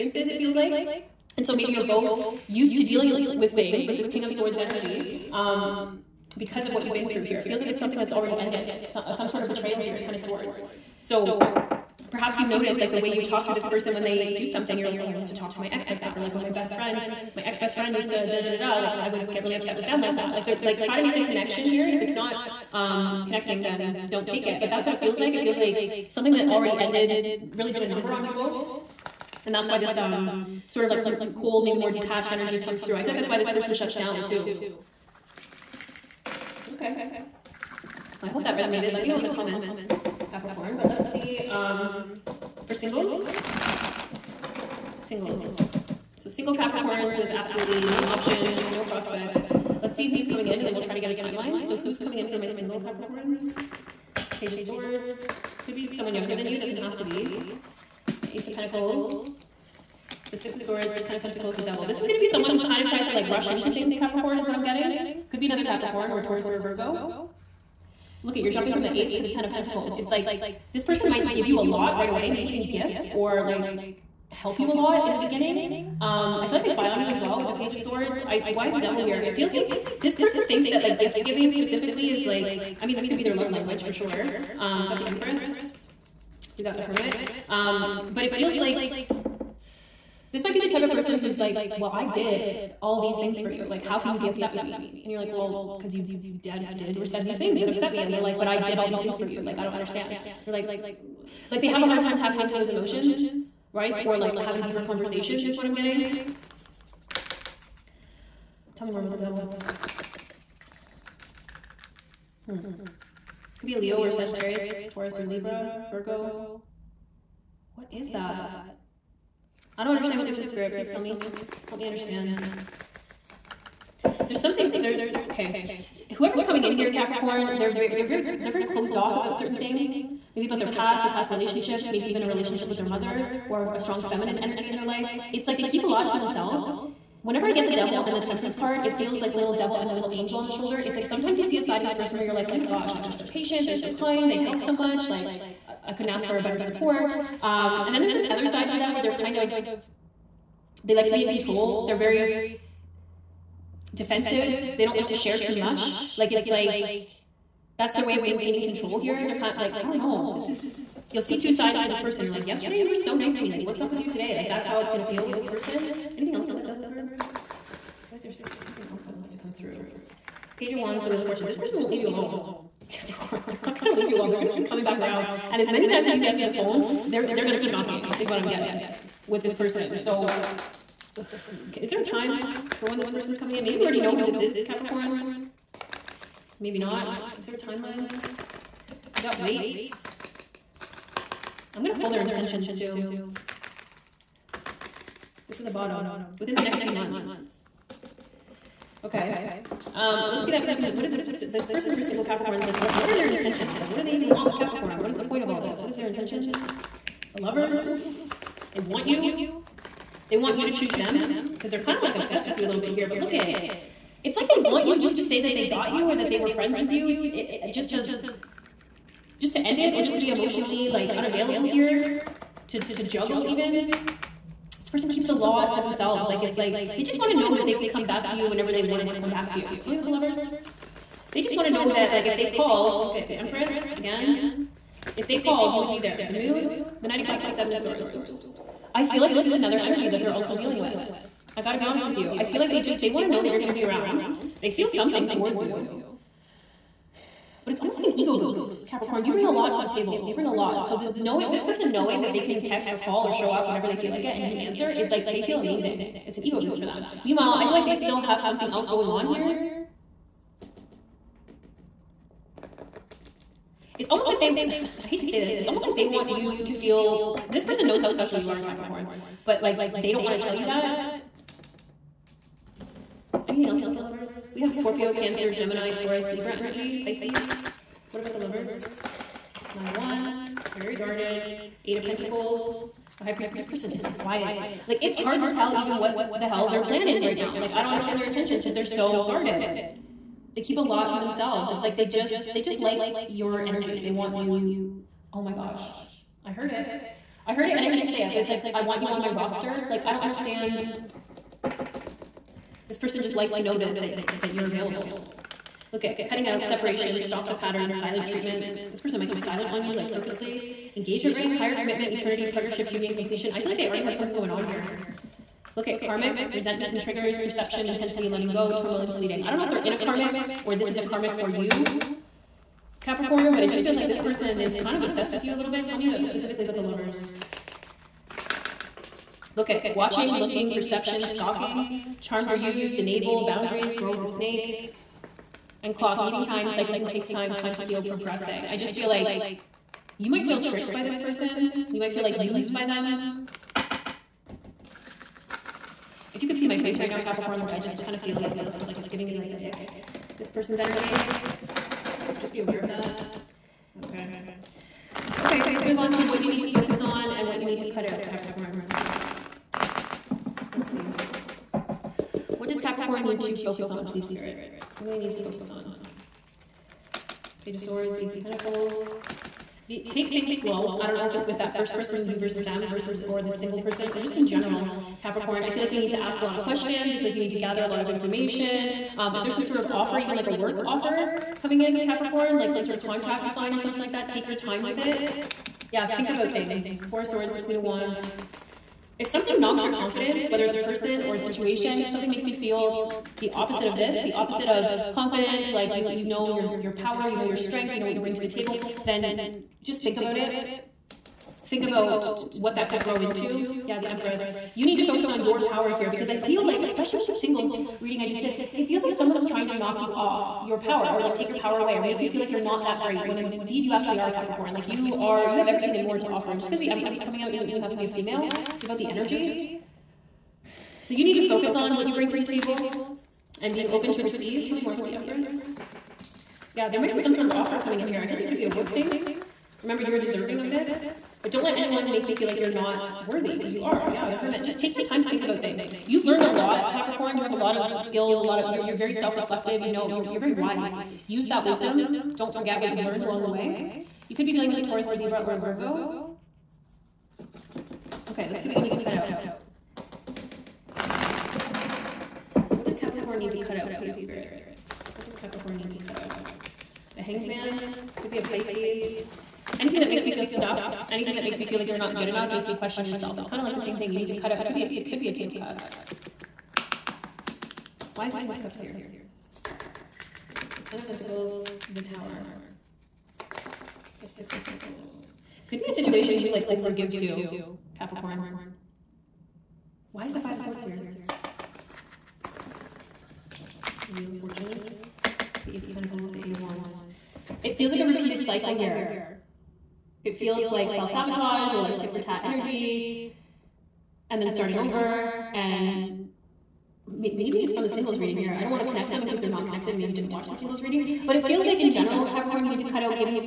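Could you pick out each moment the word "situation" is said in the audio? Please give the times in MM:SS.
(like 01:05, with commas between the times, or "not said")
06:31, 07:55.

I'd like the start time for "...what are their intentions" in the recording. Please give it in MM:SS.
03:23.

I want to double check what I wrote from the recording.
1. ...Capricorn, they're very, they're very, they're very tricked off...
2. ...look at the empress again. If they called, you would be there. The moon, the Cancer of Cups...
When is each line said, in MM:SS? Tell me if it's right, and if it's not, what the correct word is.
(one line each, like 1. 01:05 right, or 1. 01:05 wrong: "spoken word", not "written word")
1. 02:06 wrong: "closed", not "tricked"
2. 03:53 wrong: "Knight", not "Cancer".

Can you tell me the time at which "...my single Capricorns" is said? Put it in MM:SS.
00:52.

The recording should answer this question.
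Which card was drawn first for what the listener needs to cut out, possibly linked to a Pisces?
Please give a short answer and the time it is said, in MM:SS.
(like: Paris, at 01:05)
The Hanged Man, at 07:37.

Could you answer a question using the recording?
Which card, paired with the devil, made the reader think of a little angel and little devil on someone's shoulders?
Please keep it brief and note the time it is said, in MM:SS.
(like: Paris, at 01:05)
Temperance, at 02:18.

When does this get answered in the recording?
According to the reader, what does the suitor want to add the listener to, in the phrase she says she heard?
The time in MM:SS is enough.
04:59.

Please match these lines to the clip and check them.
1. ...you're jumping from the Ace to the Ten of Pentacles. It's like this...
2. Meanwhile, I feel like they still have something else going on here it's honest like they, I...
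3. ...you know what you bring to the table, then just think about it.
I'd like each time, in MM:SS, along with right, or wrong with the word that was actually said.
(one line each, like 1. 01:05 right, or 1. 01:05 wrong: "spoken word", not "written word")
1. 01:08 right
2. 04:17 wrong: "almost", not "honest"
3. 06:37 right.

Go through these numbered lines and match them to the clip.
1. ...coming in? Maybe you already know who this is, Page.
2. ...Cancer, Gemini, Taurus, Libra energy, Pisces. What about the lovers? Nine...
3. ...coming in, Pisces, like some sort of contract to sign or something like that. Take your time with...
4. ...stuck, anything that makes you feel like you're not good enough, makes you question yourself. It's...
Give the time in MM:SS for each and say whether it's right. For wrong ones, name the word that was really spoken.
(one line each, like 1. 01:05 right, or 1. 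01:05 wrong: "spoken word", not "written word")
1. 03:03 wrong: "Capricorn", not "Page"
2. 04:35 right
3. 06:21 wrong: "Capricorn", not "Pisces"
4. 07:40 right.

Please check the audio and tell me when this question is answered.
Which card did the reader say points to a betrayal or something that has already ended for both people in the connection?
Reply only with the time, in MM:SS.
00:10.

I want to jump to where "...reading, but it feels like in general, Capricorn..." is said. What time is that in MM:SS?
08:20.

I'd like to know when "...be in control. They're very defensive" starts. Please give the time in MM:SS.
02:31.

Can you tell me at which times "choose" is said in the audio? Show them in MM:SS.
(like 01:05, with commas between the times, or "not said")
03:30.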